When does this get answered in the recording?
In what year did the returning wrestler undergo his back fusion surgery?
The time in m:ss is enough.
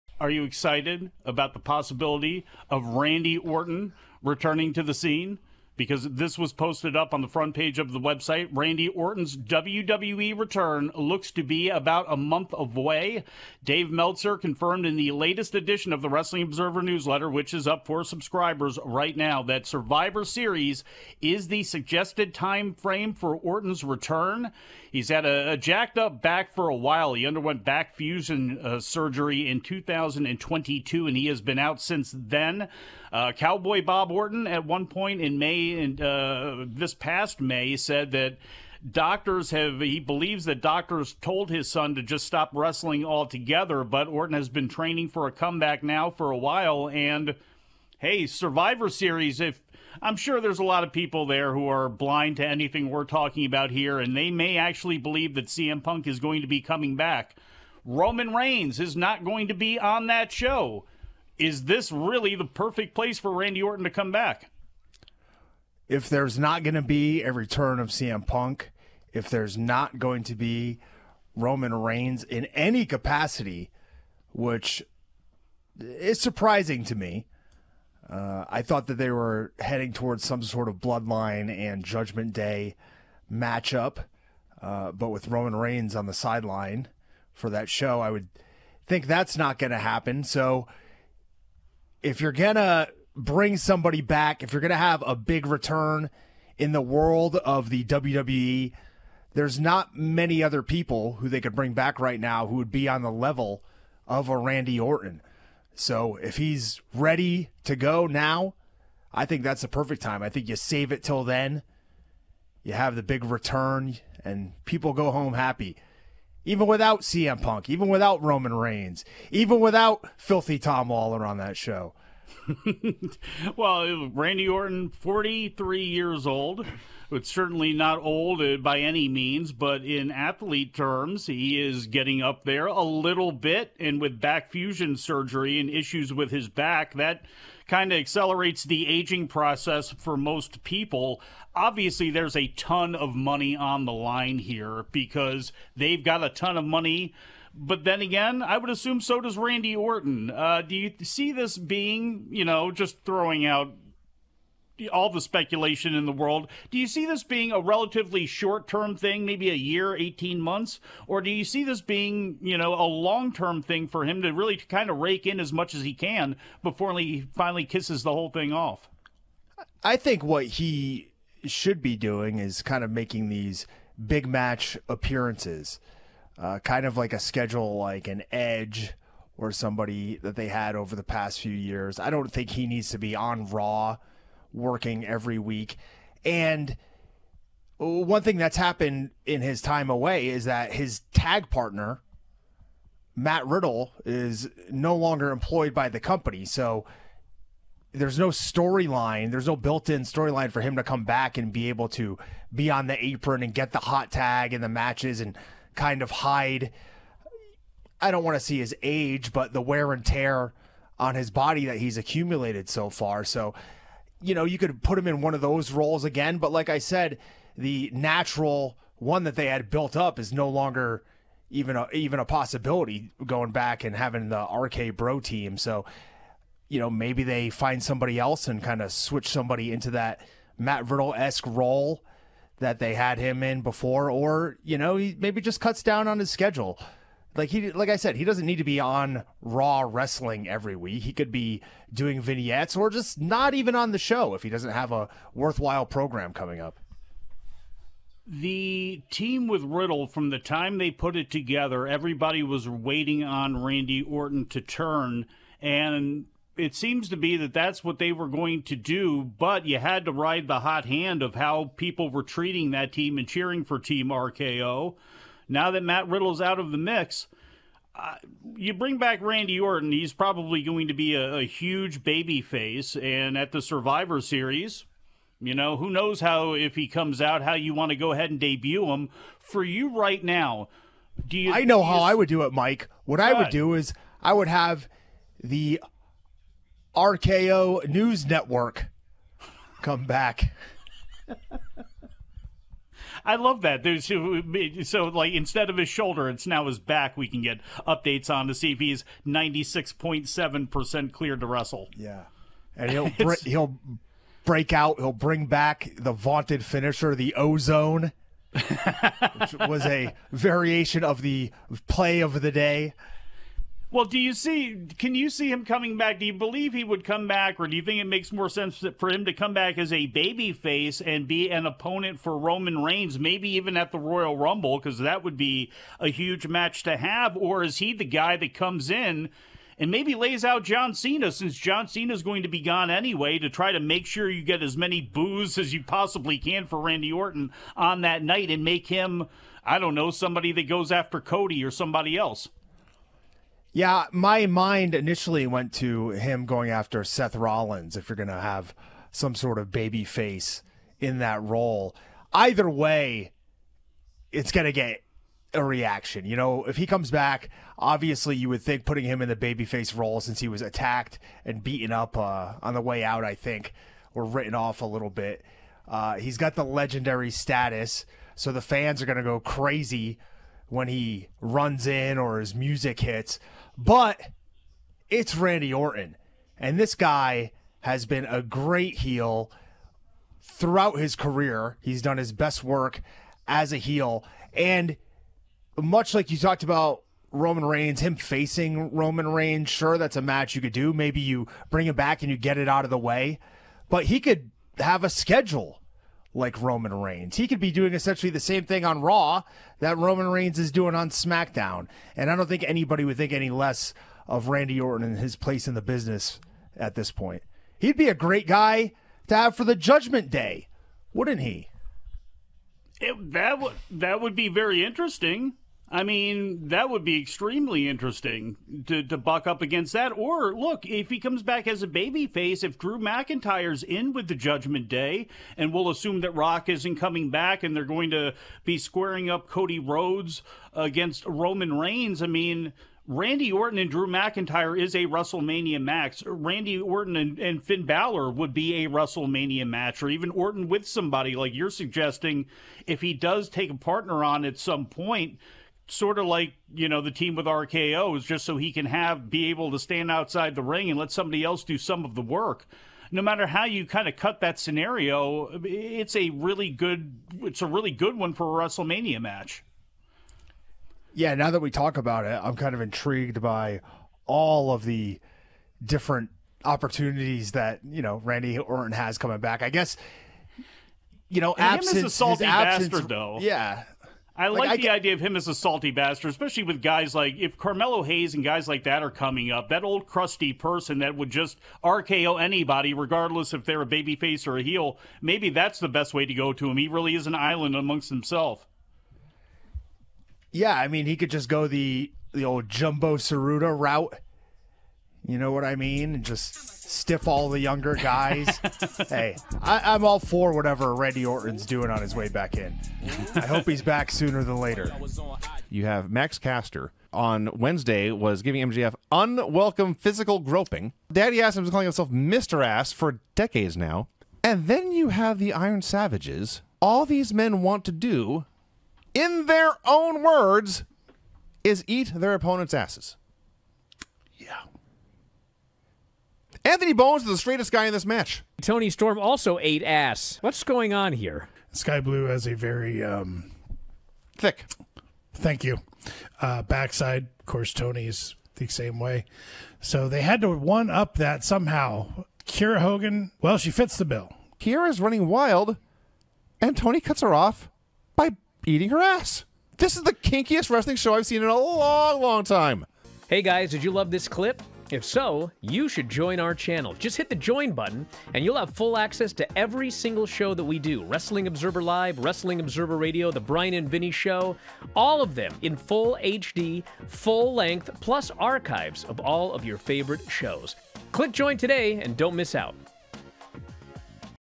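0:29.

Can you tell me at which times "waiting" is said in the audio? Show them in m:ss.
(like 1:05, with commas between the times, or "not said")
4:12.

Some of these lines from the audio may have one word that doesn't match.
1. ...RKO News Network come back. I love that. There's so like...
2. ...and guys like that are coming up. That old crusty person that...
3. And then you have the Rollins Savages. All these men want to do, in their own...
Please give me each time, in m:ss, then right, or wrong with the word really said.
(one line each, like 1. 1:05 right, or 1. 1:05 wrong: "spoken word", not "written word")
1. 4:46 right
2. 7:58 right
3. 8:34 wrong: "Iron", not "Rollins".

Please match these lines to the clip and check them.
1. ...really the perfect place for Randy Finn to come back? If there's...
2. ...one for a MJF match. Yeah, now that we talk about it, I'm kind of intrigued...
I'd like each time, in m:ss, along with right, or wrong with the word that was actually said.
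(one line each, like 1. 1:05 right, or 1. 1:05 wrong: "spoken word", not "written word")
1. 1:01 wrong: "Orton", not "Finn"
2. 7:38 wrong: "WrestleMania", not "MJF".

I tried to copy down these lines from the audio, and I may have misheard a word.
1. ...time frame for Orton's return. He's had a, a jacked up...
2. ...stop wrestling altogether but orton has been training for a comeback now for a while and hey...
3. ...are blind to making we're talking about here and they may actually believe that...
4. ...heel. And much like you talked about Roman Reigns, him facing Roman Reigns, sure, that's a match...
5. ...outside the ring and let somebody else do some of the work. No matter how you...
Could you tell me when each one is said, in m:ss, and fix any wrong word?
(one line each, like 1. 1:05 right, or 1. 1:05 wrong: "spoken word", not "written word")
1. 0:22 right
2. 0:42 right
3. 0:51 wrong: "anything", not "making"
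4. 6:23 right
5. 7:30 right.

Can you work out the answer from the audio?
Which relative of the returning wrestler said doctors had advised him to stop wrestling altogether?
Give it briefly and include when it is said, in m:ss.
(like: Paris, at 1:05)
Cowboy Bob Orton, at 0:33.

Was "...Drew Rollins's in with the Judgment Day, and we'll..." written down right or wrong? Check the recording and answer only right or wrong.
wrong.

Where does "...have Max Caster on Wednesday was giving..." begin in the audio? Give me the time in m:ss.
8:25.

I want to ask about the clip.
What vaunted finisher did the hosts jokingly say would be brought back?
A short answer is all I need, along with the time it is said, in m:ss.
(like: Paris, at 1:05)
the ozone, at 5:07.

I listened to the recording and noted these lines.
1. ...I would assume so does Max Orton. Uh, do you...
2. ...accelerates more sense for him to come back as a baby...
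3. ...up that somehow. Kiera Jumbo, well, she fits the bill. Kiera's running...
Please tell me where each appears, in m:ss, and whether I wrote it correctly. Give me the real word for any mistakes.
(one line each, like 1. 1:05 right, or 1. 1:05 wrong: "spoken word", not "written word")
1. 2:28 wrong: "Randy", not "Max"
2. 5:18 wrong: "makes", not "accelerates"
3. 9:00 wrong: "Hogan", not "Jumbo".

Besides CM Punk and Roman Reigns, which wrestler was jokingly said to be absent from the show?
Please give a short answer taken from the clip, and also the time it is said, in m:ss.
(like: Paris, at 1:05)
Tom Lawlor, at 2:00.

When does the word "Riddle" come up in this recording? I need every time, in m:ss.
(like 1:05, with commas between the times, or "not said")
3:13, 3:50, 4:09, 4:26.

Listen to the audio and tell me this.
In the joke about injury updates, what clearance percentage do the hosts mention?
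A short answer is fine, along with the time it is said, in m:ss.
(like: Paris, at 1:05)
96.7 percent, at 4:59.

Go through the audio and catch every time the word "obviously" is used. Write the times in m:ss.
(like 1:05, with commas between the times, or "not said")
2:21, 5:57.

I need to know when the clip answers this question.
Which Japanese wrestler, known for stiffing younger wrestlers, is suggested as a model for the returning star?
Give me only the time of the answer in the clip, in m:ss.
8:12.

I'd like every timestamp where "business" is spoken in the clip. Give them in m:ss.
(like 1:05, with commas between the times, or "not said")
6:45.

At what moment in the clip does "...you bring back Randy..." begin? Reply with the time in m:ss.
4:28.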